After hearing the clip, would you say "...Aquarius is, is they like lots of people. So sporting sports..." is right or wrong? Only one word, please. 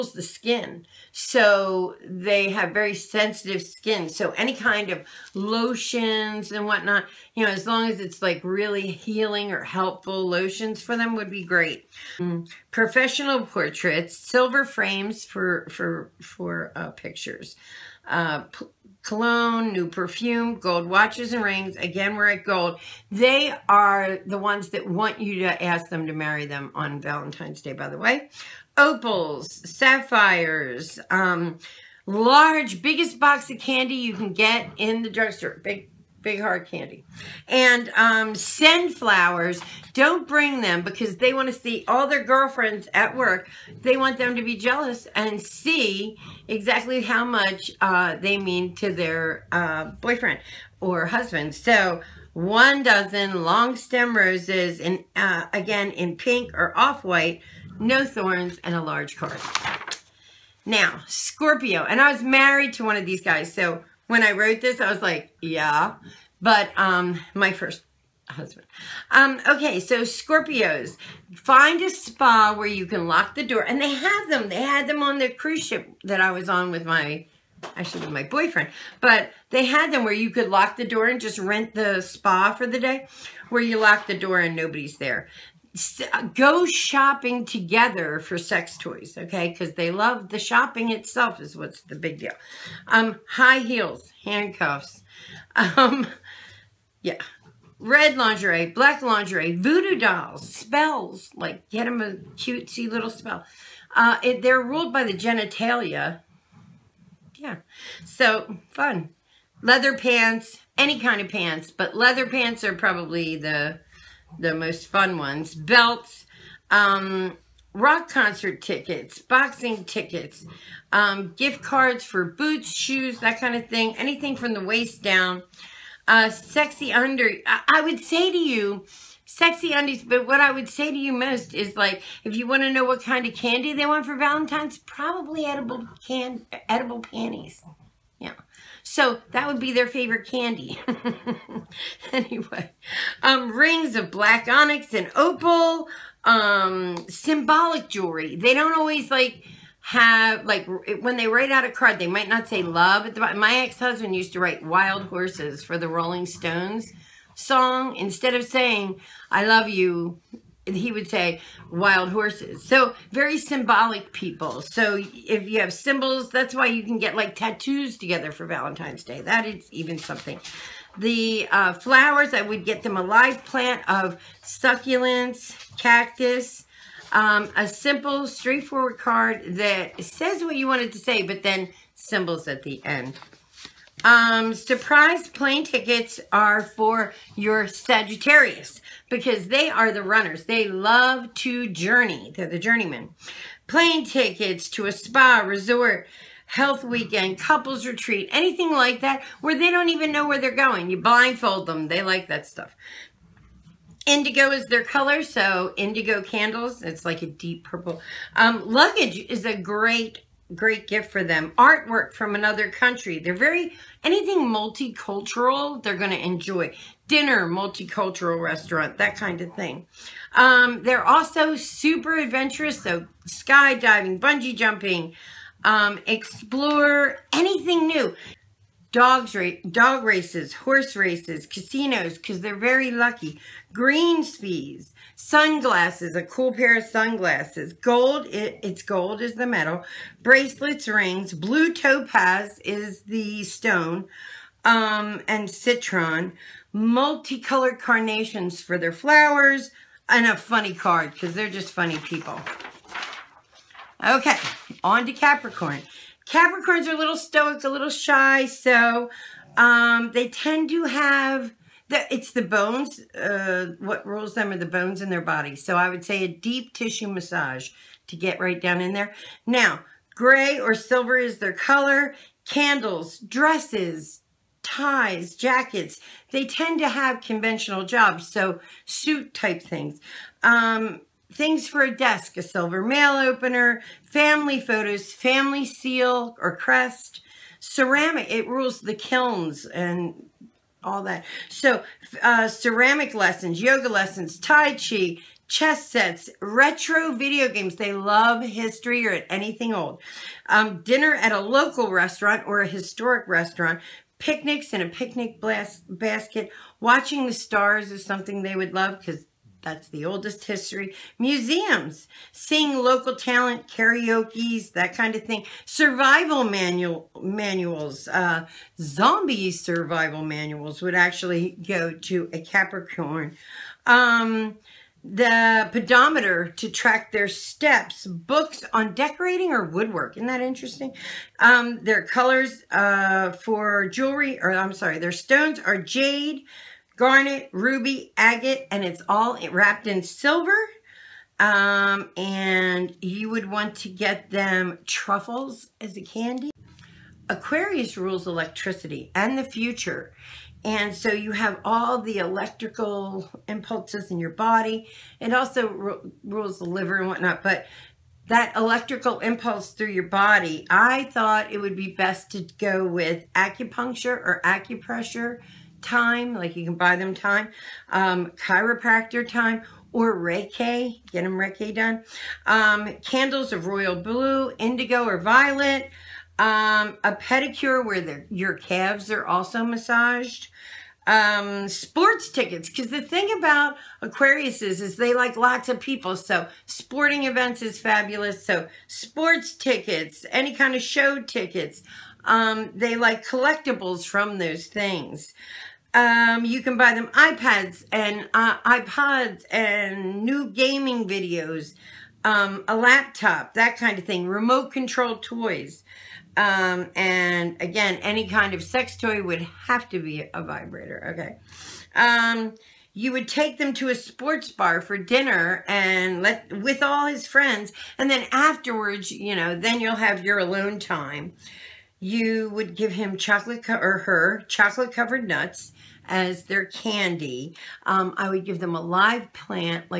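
wrong.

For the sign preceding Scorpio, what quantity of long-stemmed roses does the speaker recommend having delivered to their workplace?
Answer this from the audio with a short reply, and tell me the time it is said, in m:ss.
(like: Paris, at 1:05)
1 dozen, at 0:52.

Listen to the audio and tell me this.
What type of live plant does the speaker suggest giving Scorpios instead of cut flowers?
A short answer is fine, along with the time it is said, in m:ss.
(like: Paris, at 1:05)
Succulents, at 2:54.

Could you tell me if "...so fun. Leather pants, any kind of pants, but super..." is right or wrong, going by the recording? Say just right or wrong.
wrong.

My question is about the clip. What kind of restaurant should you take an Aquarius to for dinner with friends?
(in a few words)
Sports bar.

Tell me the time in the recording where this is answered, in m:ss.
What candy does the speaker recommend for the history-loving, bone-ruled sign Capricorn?
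5:44.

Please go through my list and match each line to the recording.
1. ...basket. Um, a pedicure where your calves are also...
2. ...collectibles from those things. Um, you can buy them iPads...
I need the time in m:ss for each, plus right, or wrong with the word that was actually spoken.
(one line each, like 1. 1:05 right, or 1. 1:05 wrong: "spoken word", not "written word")
1. 6:15 wrong: "violet", not "basket"
2. 6:33 right.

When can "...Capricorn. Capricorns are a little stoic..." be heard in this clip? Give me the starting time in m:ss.
4:15.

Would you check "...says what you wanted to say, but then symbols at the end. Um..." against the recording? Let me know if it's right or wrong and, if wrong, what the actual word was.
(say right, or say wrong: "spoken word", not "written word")
right.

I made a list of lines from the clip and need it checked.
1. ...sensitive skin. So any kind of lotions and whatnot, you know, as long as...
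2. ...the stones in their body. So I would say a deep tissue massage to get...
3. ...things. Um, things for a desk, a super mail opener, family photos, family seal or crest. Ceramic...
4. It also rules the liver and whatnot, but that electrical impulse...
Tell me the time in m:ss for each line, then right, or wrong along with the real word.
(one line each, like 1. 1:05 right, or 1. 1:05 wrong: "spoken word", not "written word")
1. 0:02 right
2. 4:24 wrong: "bones", not "stones"
3. 4:39 wrong: "silver", not "super"
4. 5:55 right.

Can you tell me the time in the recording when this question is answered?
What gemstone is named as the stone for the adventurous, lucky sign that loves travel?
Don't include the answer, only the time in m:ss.
4:01.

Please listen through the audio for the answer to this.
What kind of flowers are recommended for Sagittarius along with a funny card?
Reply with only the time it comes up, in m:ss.
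4:06.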